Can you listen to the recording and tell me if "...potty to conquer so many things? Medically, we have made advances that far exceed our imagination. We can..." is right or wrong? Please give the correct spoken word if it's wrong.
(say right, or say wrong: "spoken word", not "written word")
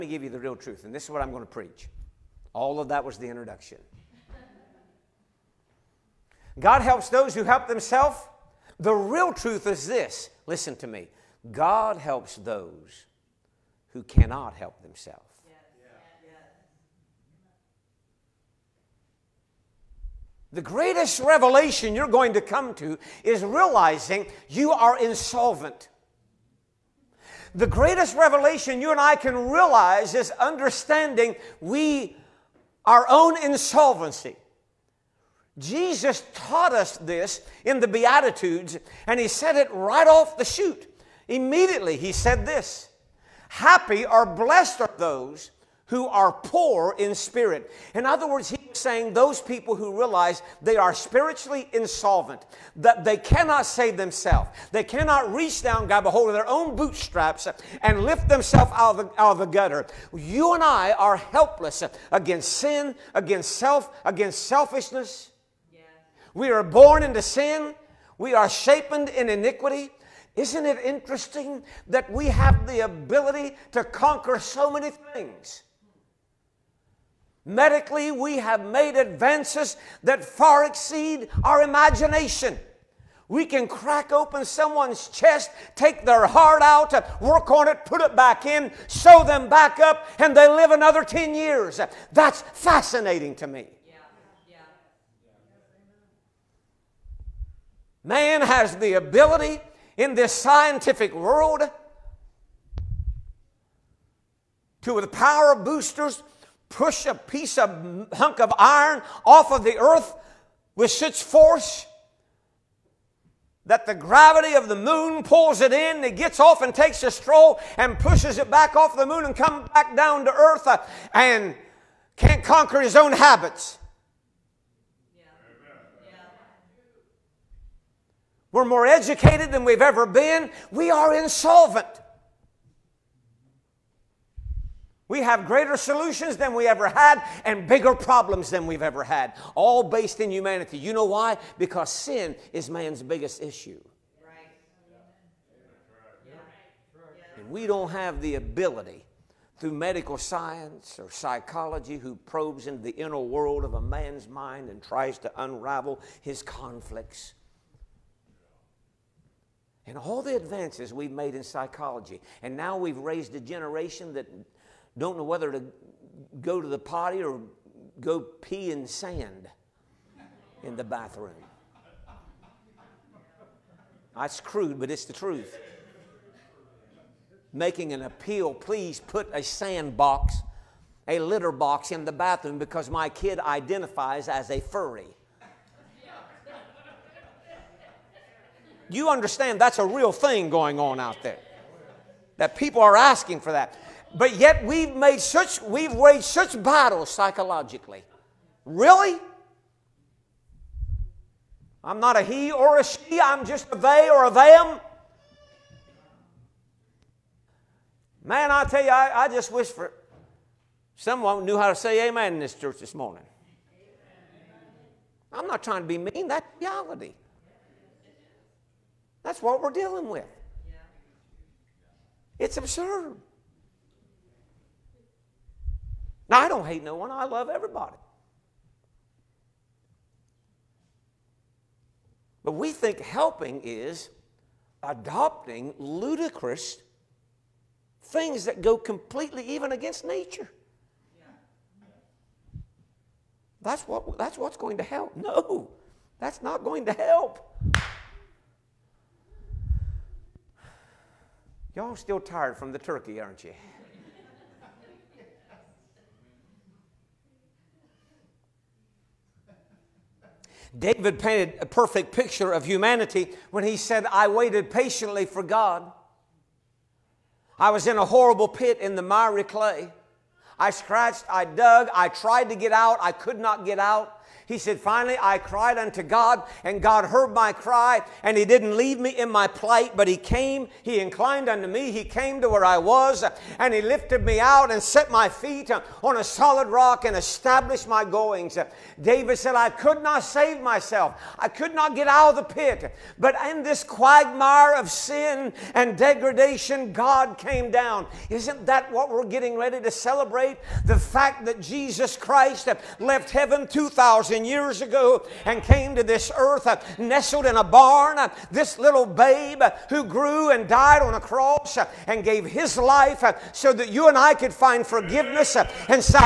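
wrong: "ability", not "potty".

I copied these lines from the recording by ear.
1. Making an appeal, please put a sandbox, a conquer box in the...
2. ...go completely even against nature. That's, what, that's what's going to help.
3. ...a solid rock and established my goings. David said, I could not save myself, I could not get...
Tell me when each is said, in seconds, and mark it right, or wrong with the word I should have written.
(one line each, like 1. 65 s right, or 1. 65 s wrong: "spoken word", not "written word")
1. 177 s wrong: "litter", not "conquer"
2. 238 s right
3. 286 s right.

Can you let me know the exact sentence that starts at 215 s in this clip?
I'm not trying to be mean, that's reality.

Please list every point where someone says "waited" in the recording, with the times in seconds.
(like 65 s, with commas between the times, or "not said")
264 s.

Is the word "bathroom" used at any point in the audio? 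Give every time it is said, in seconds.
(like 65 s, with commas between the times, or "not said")
170 s, 182 s.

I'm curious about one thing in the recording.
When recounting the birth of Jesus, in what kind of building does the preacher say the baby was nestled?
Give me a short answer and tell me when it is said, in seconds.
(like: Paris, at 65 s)
A barn, at 307 s.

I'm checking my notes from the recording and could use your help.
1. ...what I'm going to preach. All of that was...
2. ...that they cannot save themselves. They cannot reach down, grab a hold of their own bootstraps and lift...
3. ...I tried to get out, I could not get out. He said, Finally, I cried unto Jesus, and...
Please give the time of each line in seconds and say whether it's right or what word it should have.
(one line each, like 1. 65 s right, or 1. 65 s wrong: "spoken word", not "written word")
1. 1 s right
2. 52 s right
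3. 271 s wrong: "God", not "Jesus".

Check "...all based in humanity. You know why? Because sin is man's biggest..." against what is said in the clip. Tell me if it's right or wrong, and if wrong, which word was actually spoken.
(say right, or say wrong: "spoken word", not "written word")
right.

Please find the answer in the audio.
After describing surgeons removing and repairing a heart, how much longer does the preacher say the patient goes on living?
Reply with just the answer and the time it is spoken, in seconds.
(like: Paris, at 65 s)
10 years, at 91 s.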